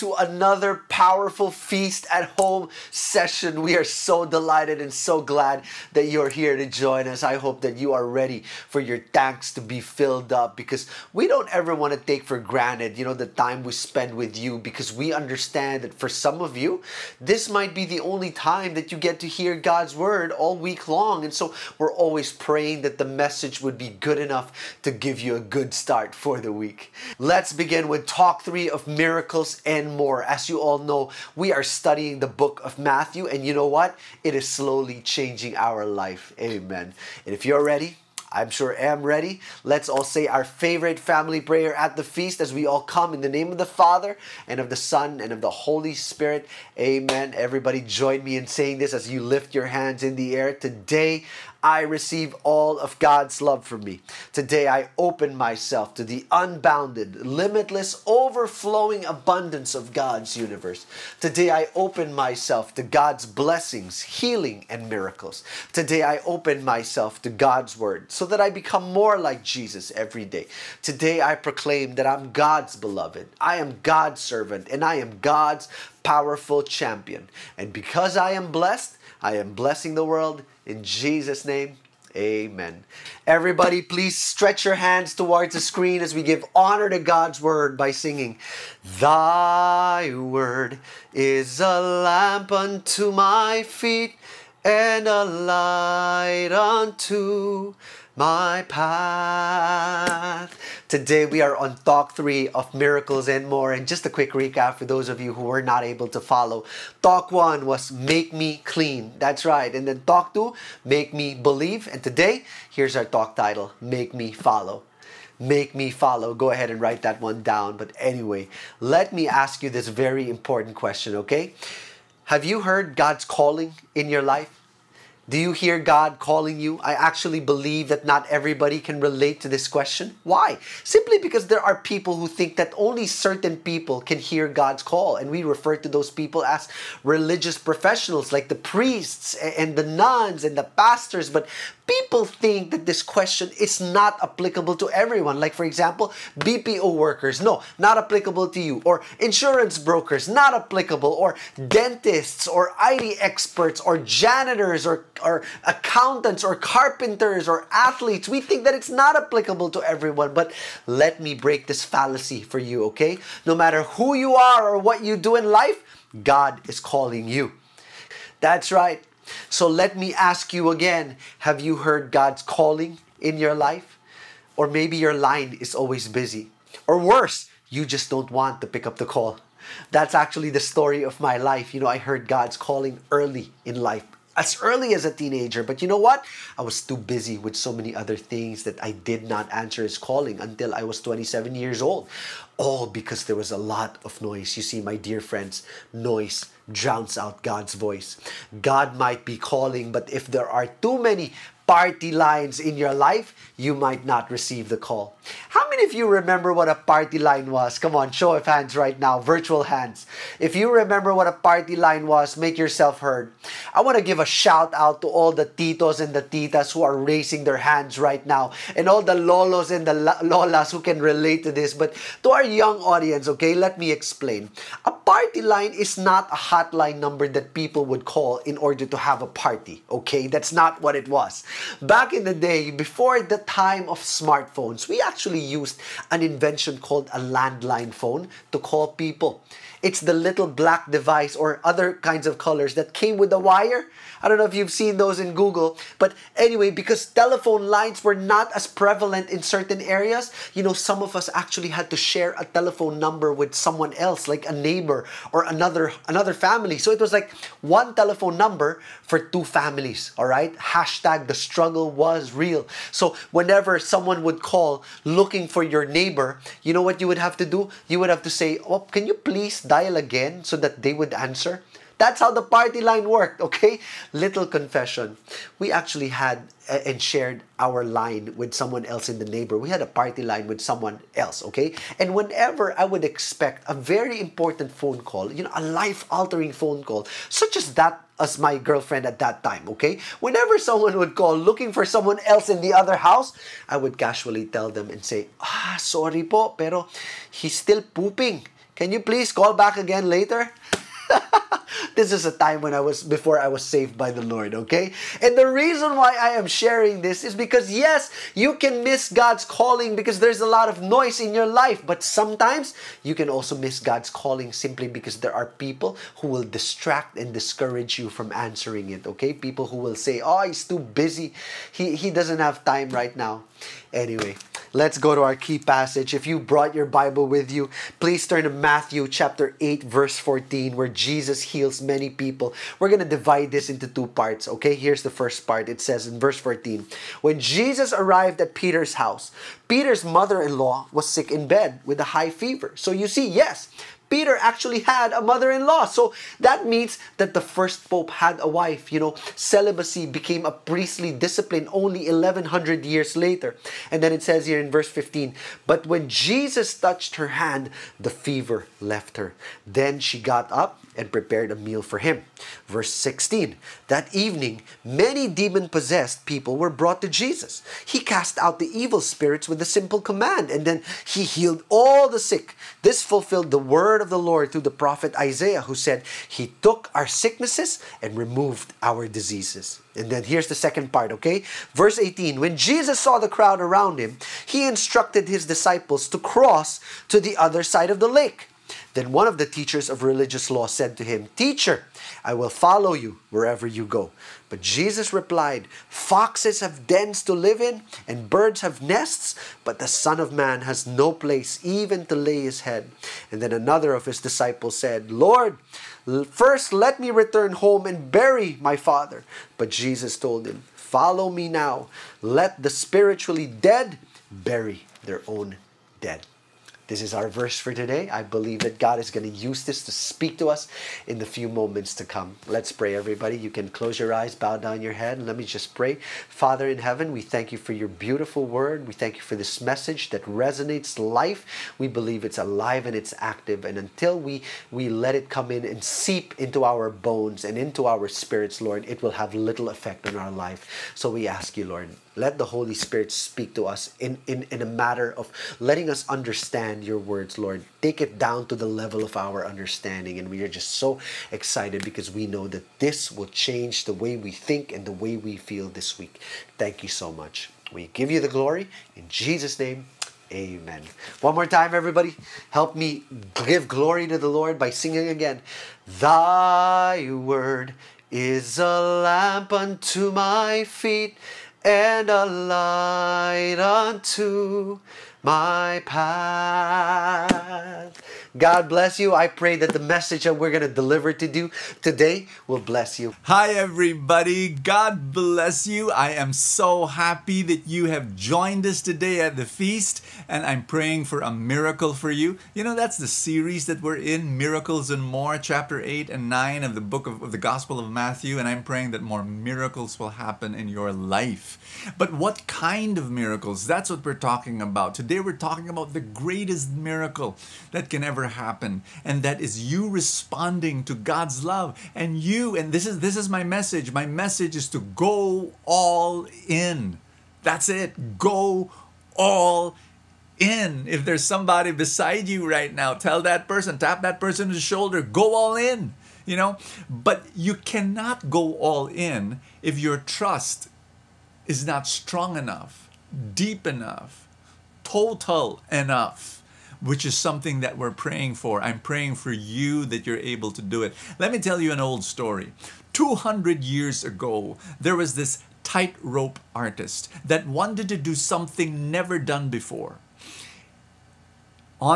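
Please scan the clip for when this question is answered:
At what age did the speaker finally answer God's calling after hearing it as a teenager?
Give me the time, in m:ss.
3:11.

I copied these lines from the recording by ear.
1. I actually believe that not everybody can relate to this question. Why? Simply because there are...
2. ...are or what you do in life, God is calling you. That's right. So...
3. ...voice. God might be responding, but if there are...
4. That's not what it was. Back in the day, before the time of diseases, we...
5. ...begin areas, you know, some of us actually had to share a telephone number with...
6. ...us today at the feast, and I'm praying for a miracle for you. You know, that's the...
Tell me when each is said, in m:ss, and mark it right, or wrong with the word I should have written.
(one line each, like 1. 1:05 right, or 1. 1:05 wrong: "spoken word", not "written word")
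1. 2:06 right
2. 2:44 right
3. 3:17 wrong: "calling", not "responding"
4. 3:50 wrong: "smartphones", not "diseases"
5. 4:09 wrong: "certain", not "begin"
6. 8:08 right.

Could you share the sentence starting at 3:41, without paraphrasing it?
But to our young audience, okay, let me explain.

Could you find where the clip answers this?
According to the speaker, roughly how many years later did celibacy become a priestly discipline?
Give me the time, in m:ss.
5:52.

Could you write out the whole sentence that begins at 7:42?
Help me give glory to the Lord by singing again.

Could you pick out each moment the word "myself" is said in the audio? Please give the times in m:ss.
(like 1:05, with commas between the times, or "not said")
0:55, 1:02, 1:06.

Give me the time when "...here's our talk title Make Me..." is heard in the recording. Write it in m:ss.
1:52.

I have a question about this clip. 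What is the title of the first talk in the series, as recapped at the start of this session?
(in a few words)
Make Me Clean.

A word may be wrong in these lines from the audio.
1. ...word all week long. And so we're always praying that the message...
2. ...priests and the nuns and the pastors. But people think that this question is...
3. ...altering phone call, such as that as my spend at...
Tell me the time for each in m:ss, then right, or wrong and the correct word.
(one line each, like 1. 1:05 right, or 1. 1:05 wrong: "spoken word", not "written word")
1. 0:19 right
2. 2:18 right
3. 4:46 wrong: "girlfriend", not "spend".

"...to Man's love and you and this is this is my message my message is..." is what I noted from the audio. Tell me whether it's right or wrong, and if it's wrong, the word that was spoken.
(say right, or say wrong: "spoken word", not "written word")
wrong: "God", not "Man".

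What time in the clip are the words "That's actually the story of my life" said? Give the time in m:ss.
2:59.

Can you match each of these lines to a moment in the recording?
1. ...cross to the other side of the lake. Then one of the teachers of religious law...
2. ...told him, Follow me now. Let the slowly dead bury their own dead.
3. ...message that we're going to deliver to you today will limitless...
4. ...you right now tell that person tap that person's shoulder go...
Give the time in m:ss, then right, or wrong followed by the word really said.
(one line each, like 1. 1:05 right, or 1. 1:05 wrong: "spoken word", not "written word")
1. 6:26 right
2. 6:50 wrong: "spiritually", not "slowly"
3. 7:59 wrong: "bless", not "limitless"
4. 8:42 right.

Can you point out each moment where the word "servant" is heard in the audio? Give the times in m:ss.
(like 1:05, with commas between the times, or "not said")
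1:14.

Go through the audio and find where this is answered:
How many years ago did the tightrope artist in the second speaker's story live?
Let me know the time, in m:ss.
9:02.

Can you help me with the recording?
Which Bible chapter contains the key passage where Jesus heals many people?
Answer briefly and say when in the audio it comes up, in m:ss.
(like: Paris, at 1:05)
Matthew chapter 8, at 5:28.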